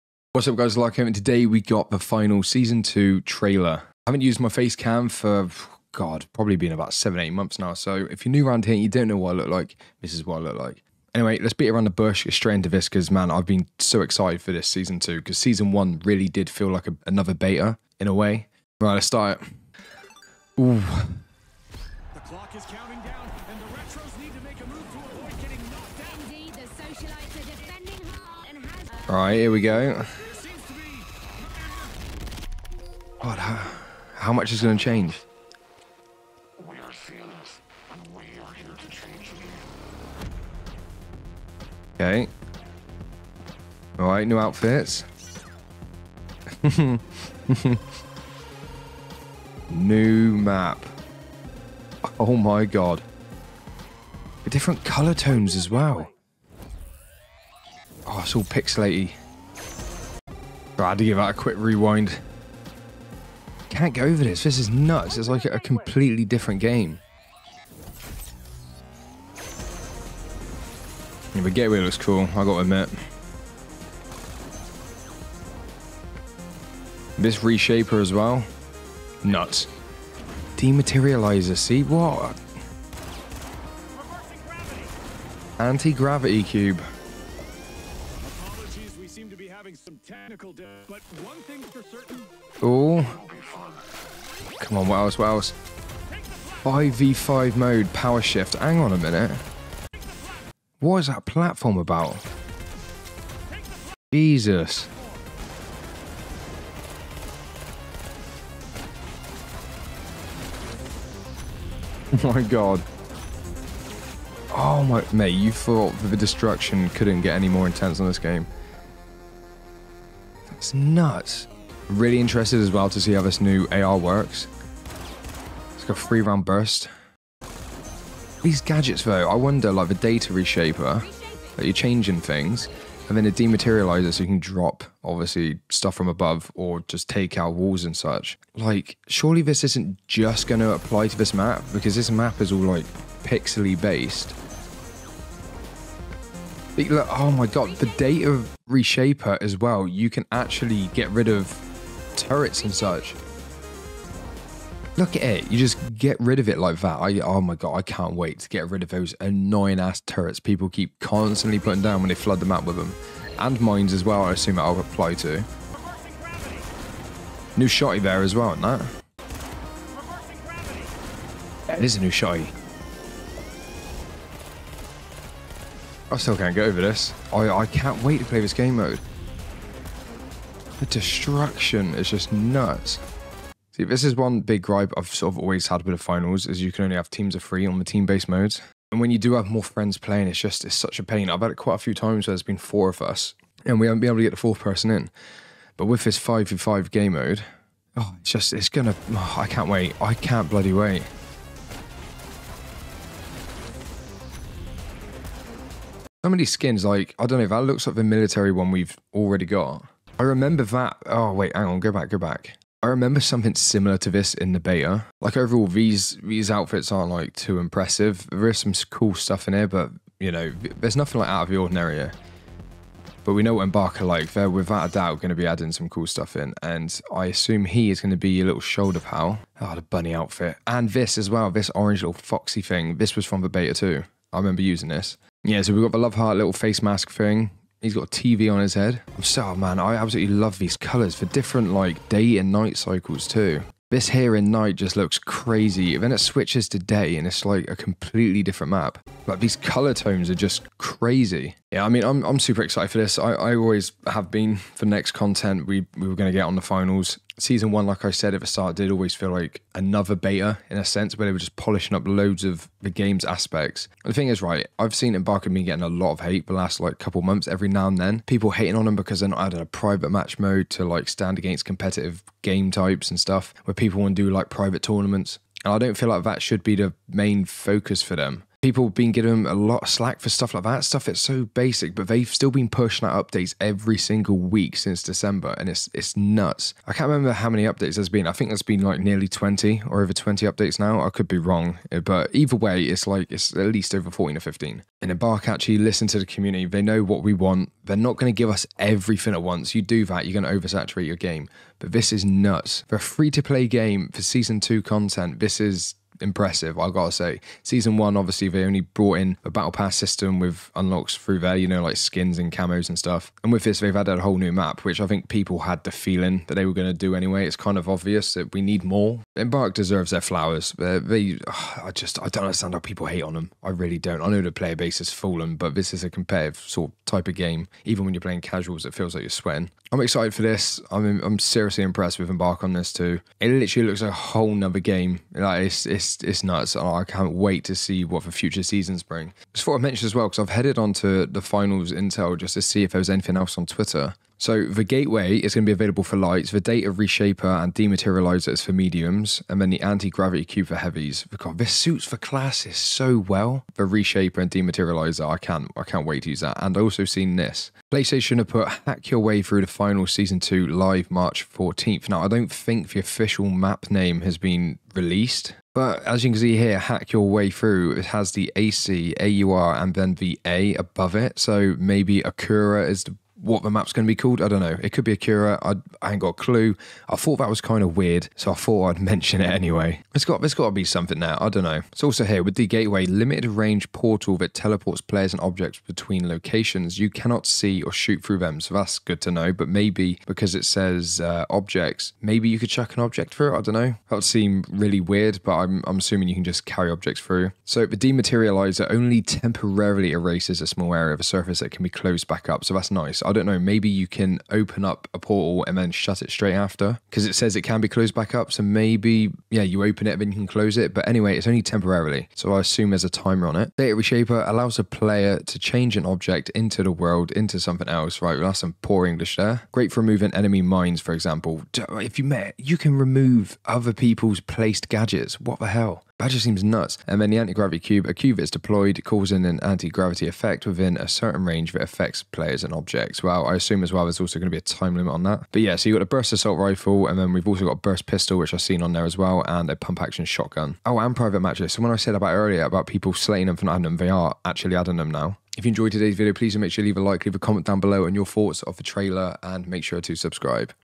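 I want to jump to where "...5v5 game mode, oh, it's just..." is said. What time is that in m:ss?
3:16.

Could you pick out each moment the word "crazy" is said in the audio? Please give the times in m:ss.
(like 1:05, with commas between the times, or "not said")
4:05, 4:10.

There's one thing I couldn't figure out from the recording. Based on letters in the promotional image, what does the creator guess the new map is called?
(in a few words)
Akura.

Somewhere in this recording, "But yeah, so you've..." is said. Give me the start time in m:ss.
7:15.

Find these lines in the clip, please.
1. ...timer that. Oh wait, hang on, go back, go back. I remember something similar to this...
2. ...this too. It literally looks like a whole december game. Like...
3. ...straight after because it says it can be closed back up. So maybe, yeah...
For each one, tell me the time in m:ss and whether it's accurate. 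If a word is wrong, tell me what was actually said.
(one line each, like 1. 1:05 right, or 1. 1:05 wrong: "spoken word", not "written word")
1. 3:30 wrong: "remember", not "timer"
2. 5:32 wrong: "nother", not "december"
3. 6:46 right.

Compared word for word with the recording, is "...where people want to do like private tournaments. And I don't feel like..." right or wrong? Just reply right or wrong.
right.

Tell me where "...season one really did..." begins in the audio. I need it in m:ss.
0:15.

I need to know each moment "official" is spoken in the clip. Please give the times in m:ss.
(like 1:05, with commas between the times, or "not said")
6:02.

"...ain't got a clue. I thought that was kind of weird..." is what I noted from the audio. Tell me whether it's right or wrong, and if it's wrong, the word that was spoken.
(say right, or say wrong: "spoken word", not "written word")
right.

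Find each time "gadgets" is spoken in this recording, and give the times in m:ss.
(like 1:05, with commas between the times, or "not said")
2:08, 7:04.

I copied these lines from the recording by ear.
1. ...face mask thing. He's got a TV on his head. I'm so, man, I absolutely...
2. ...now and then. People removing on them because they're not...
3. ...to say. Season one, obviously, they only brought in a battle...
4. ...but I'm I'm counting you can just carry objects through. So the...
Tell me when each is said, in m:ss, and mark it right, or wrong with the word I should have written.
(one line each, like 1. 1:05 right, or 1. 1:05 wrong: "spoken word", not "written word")
1. 3:56 right
2. 4:27 wrong: "hating", not "removing"
3. 5:07 right
4. 6:35 wrong: "assuming", not "counting".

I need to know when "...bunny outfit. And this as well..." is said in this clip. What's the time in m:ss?
3:49.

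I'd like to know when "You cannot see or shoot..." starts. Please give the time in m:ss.
6:26.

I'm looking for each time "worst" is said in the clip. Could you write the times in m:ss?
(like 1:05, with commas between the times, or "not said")
not said.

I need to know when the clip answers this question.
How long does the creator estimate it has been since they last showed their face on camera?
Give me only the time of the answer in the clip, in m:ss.
0:06.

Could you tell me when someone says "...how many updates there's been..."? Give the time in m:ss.
4:47.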